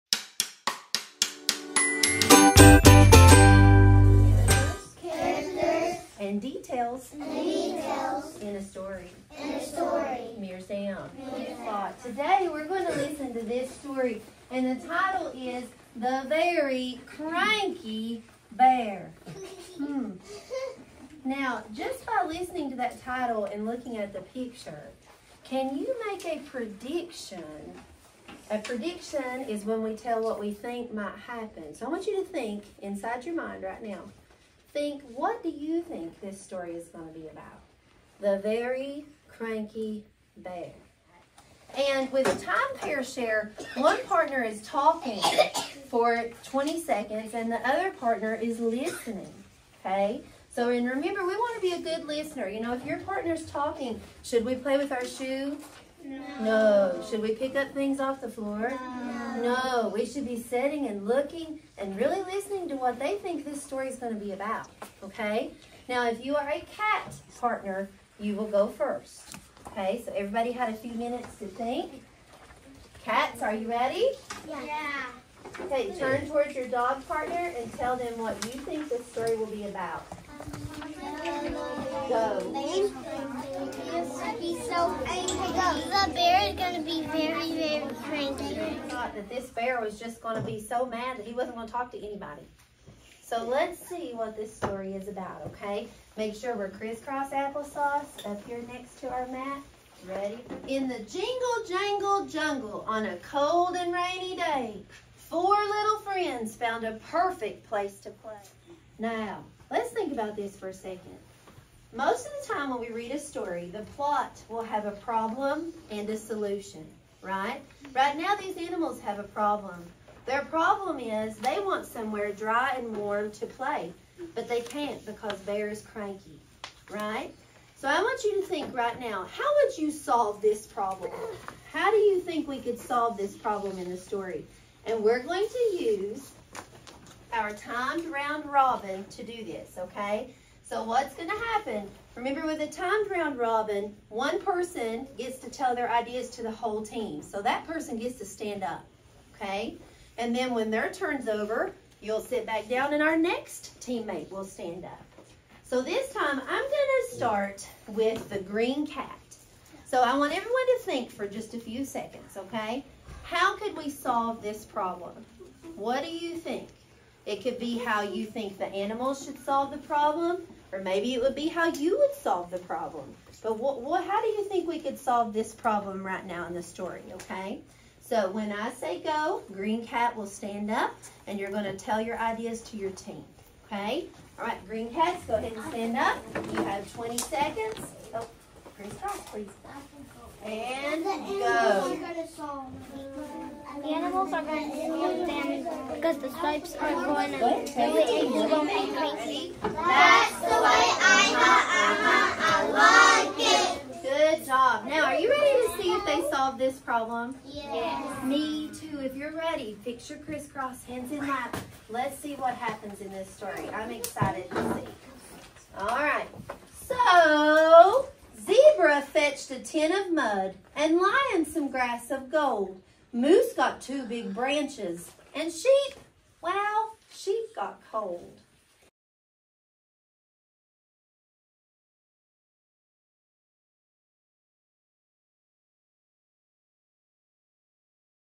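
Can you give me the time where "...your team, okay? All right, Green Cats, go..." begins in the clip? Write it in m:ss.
3:02.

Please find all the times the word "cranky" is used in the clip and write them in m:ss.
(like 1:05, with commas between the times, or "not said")
0:17, 0:39, 1:28, 2:05.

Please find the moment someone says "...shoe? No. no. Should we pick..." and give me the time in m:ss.
0:55.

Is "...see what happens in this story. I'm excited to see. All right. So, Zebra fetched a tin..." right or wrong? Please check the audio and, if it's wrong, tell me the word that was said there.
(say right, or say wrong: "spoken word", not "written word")
right.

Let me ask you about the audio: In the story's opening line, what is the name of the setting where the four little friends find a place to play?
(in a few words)
jingle jangle jungle.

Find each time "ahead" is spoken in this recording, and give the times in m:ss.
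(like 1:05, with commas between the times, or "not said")
3:05.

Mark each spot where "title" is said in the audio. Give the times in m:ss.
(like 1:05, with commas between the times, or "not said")
0:14, 0:23.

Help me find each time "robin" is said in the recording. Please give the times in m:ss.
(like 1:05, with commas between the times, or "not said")
2:18, 2:23.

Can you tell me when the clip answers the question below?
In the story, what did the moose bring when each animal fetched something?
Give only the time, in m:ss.
3:43.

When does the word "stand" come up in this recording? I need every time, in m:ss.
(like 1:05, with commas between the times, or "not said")
2:28, 2:34, 3:00, 3:05.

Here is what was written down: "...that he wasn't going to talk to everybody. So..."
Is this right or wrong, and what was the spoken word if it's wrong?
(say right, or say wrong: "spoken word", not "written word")
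wrong: "anybody", not "everybody".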